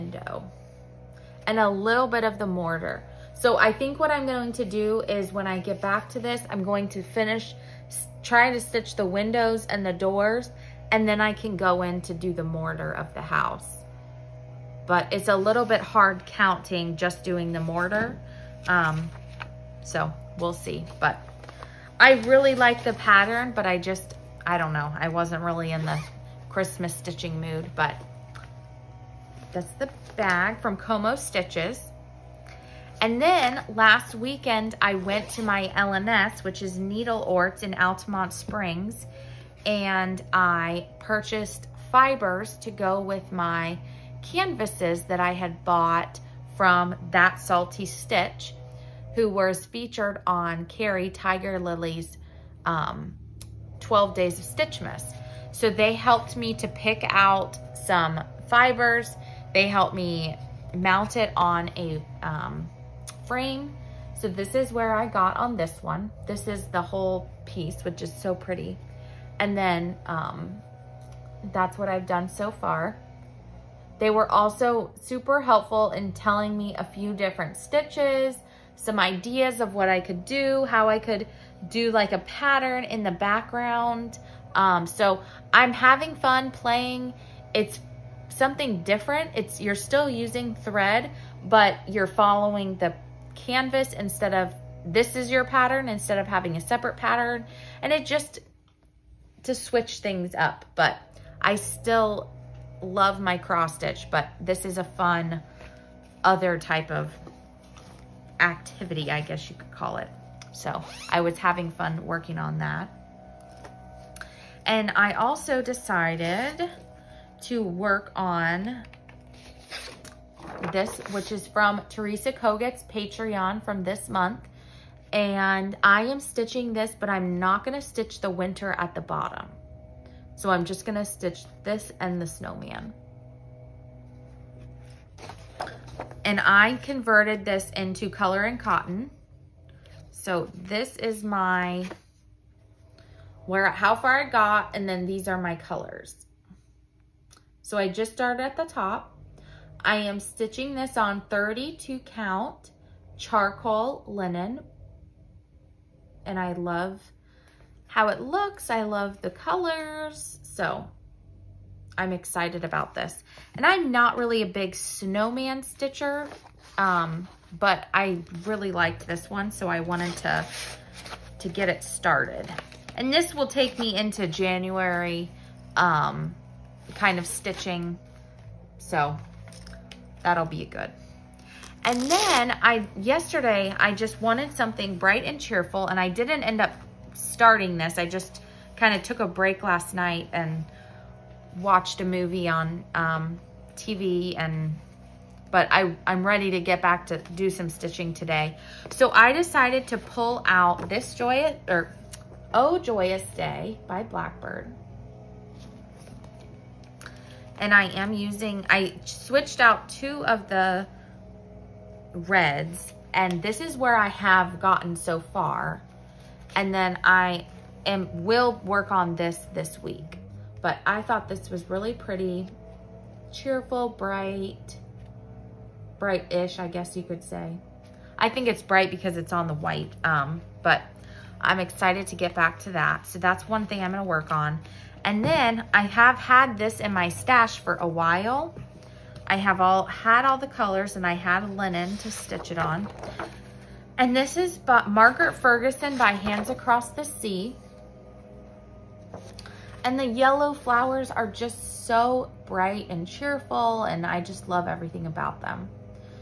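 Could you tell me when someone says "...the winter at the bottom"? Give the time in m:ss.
2:08.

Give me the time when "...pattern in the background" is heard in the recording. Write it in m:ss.
1:22.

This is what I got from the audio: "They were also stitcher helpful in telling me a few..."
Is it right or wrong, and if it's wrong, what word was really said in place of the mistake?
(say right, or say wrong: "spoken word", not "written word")
wrong: "super", not "stitcher".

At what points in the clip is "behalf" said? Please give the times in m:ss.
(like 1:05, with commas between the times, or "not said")
not said.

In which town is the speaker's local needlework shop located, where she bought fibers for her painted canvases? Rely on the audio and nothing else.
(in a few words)
Altamonte Springs.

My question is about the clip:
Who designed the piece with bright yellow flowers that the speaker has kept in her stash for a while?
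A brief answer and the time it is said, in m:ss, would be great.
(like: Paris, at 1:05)
Margaret Ferguson, at 4:04.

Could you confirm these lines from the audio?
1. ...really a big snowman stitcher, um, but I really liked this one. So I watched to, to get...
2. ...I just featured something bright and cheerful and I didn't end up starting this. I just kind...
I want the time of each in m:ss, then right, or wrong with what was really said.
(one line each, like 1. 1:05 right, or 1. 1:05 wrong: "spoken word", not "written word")
1. 2:44 wrong: "wanted", not "watched"
2. 3:03 wrong: "wanted", not "featured".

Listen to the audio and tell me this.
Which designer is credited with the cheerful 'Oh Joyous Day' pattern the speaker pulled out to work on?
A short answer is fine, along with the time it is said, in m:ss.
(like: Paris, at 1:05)
Blackbird, at 3:24.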